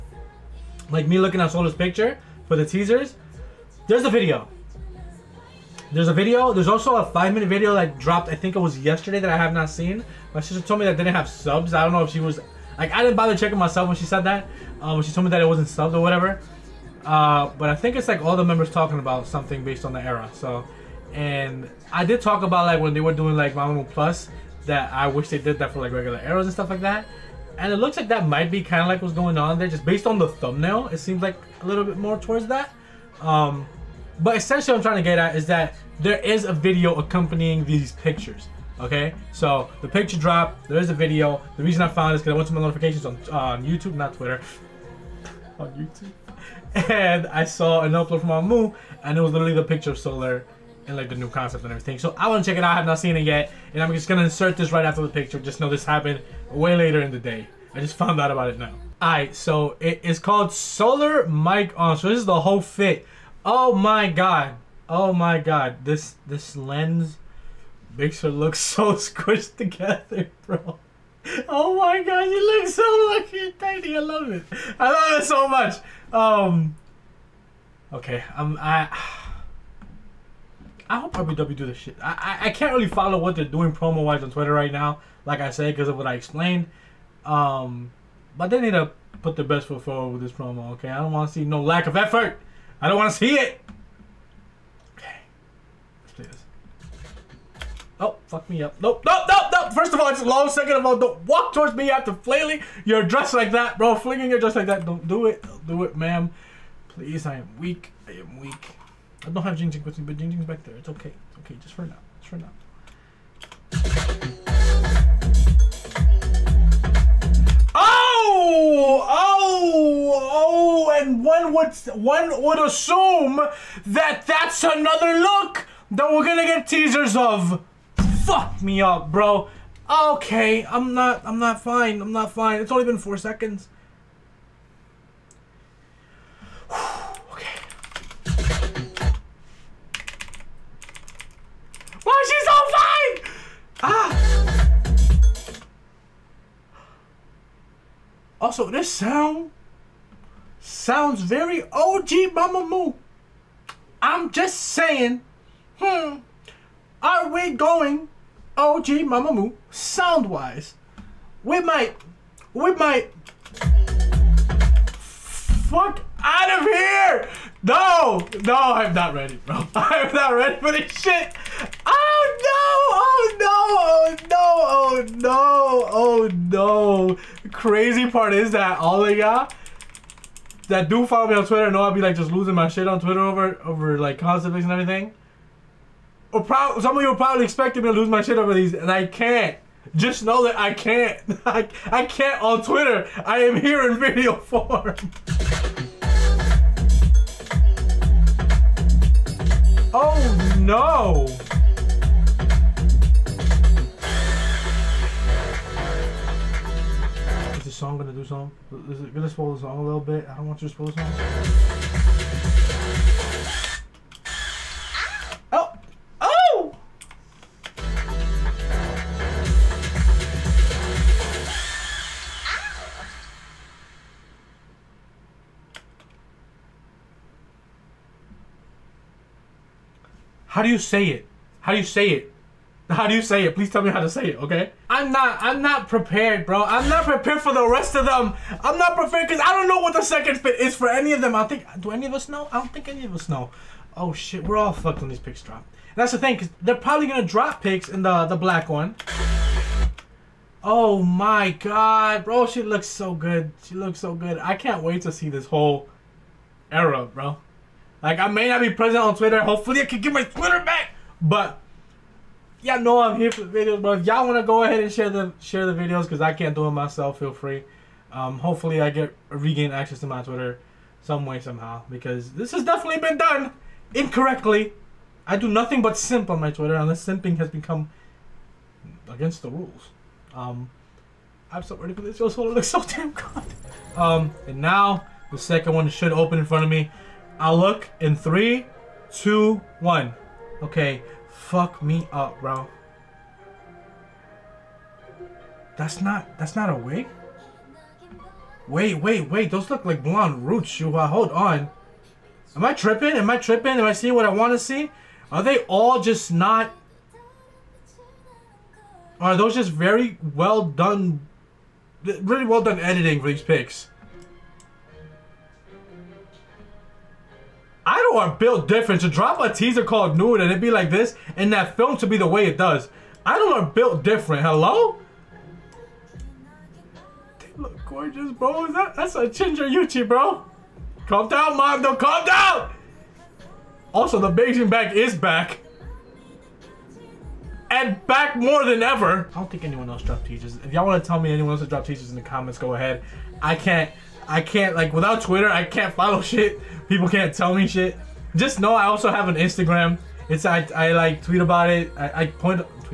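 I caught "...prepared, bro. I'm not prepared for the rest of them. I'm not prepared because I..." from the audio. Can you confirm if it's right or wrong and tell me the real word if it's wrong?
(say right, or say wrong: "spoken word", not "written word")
right.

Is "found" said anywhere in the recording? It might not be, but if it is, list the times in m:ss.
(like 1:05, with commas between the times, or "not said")
0:41, 0:57.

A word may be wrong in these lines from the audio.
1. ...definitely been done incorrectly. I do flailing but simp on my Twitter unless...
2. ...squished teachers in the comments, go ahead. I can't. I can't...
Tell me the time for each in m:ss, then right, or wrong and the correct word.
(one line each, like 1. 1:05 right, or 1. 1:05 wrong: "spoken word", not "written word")
1. 4:32 wrong: "nothing", not "flailing"
2. 5:41 wrong: "dropped", not "squished".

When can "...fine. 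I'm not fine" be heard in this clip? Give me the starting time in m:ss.
2:11.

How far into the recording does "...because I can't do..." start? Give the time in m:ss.
4:26.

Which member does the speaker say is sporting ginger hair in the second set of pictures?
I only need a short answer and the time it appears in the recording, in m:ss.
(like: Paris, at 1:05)
Yuqi, at 5:29.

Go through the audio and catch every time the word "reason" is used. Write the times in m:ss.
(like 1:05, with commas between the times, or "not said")
0:41.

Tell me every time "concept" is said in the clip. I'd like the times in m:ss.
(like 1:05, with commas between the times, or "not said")
0:51, 3:04.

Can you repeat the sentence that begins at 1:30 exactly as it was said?
Okay, I don't want to see no lack of effort.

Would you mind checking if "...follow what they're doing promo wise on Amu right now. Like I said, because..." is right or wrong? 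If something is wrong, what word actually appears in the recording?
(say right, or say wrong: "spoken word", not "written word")
wrong: "Twitter", not "Amu".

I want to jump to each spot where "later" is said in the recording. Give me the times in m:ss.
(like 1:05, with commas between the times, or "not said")
0:56.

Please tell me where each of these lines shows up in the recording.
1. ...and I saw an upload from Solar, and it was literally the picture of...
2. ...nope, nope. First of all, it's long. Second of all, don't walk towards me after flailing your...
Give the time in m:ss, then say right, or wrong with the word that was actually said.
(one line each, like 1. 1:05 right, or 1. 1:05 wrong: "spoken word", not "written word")
1. 0:46 wrong: "Amu", not "Solar"
2. 1:39 right.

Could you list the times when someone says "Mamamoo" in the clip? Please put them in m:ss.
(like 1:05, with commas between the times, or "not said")
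0:23, 2:32, 2:39.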